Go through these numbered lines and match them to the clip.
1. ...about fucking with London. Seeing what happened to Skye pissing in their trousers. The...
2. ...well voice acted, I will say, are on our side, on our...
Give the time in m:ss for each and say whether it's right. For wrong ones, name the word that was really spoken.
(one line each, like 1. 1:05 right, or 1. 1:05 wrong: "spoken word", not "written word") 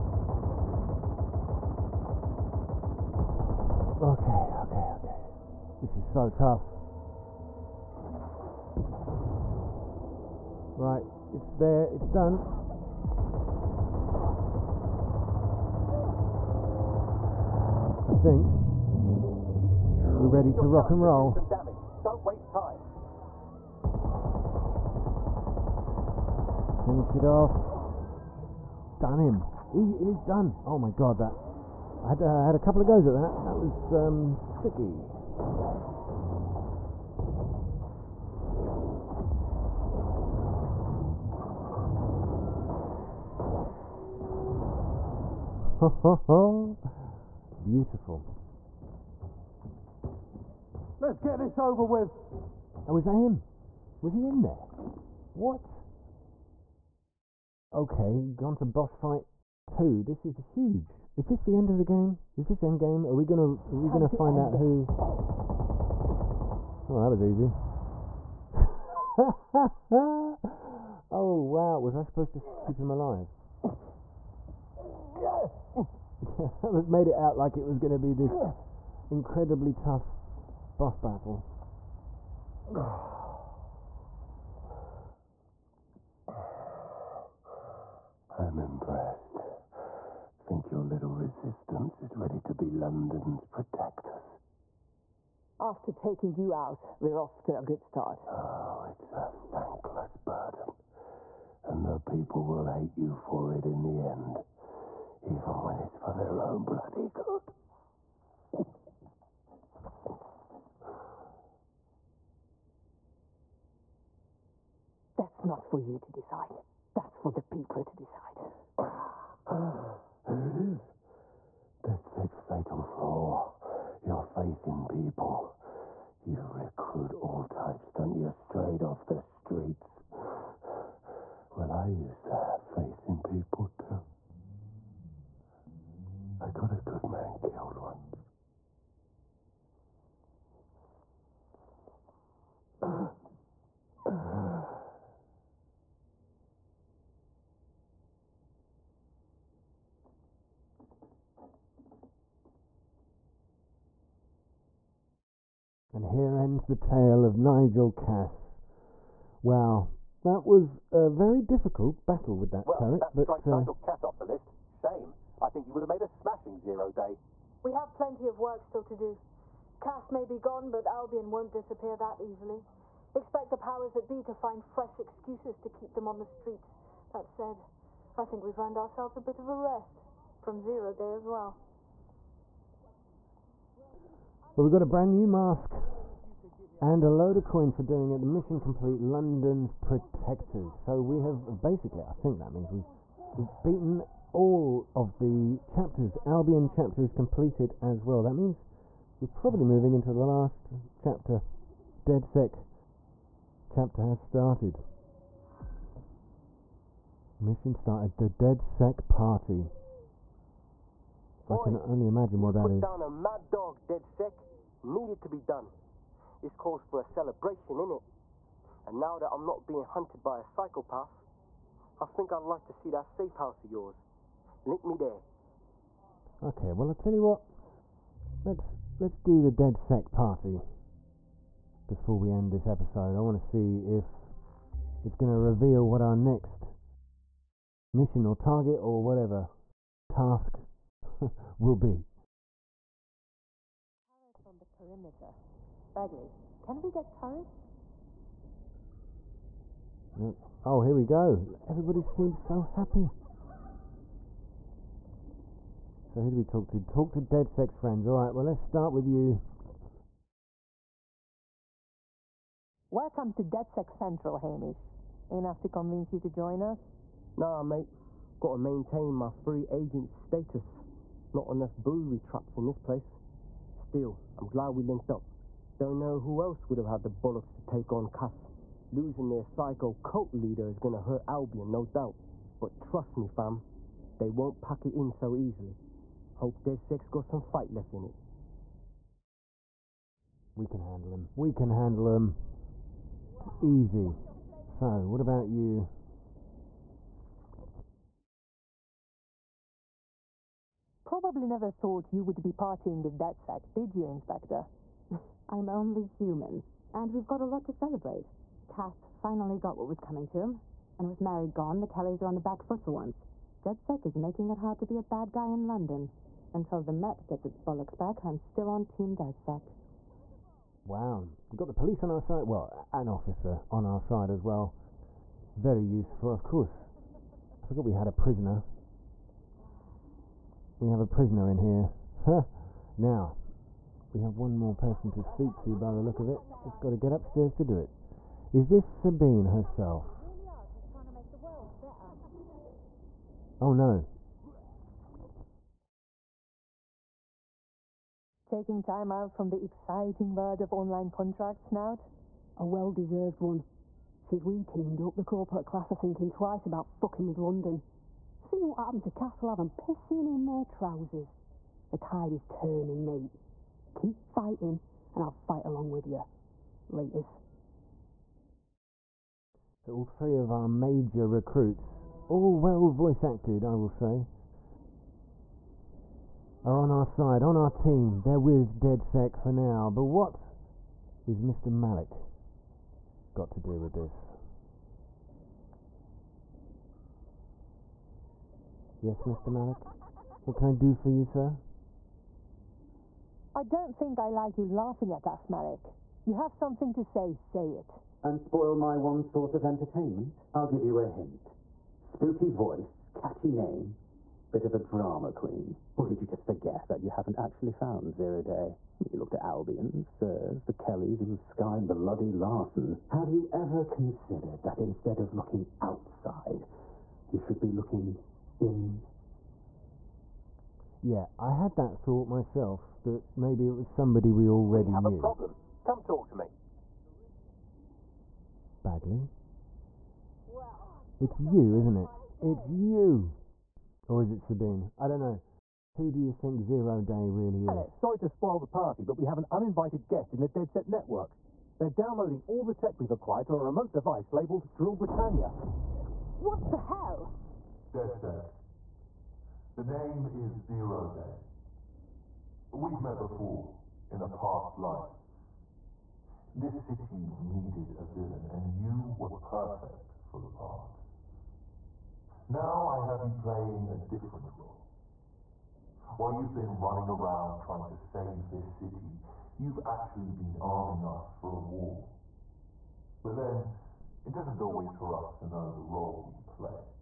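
1. 5:56 wrong: "Castlehaven", not "Skye"
2. 6:12 right.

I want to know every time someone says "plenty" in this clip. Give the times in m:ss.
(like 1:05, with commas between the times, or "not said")
2:47.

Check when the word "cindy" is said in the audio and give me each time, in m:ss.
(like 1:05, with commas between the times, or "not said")
not said.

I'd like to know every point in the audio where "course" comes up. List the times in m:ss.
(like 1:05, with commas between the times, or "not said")
5:26.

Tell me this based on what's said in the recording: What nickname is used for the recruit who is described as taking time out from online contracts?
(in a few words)
Snout.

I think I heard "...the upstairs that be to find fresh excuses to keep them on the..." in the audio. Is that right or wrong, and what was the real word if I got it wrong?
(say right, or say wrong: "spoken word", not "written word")
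wrong: "powers", not "upstairs".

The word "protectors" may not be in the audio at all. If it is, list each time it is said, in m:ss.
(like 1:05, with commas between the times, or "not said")
1:33, 3:09.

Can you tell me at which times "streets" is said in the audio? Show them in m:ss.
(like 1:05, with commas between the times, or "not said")
2:09, 2:56.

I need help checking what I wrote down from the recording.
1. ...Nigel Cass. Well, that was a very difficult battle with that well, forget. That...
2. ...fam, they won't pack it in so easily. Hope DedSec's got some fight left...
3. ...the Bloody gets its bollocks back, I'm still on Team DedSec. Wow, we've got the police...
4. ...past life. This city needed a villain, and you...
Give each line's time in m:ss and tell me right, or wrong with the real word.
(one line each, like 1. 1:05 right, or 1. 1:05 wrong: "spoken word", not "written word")
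1. 2:37 wrong: "turret", not "forget"
2. 4:43 right
3. 5:16 wrong: "Met", not "Bloody"
4. 7:34 right.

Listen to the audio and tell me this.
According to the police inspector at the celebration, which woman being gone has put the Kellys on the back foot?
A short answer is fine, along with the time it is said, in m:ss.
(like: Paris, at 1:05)
Mary, at 5:11.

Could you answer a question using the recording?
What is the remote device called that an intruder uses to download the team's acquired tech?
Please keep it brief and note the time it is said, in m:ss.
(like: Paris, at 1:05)
Drill Britannia, at 7:24.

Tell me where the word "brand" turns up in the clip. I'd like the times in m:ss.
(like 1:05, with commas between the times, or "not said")
3:04.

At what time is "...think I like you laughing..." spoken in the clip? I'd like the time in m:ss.
6:33.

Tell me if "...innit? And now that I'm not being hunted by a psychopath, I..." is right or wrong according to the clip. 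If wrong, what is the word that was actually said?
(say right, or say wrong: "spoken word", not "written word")
right.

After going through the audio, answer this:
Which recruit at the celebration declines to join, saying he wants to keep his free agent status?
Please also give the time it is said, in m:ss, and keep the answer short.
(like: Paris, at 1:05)
Hamish, at 4:24.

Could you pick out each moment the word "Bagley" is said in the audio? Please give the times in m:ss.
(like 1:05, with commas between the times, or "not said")
4:05, 7:08.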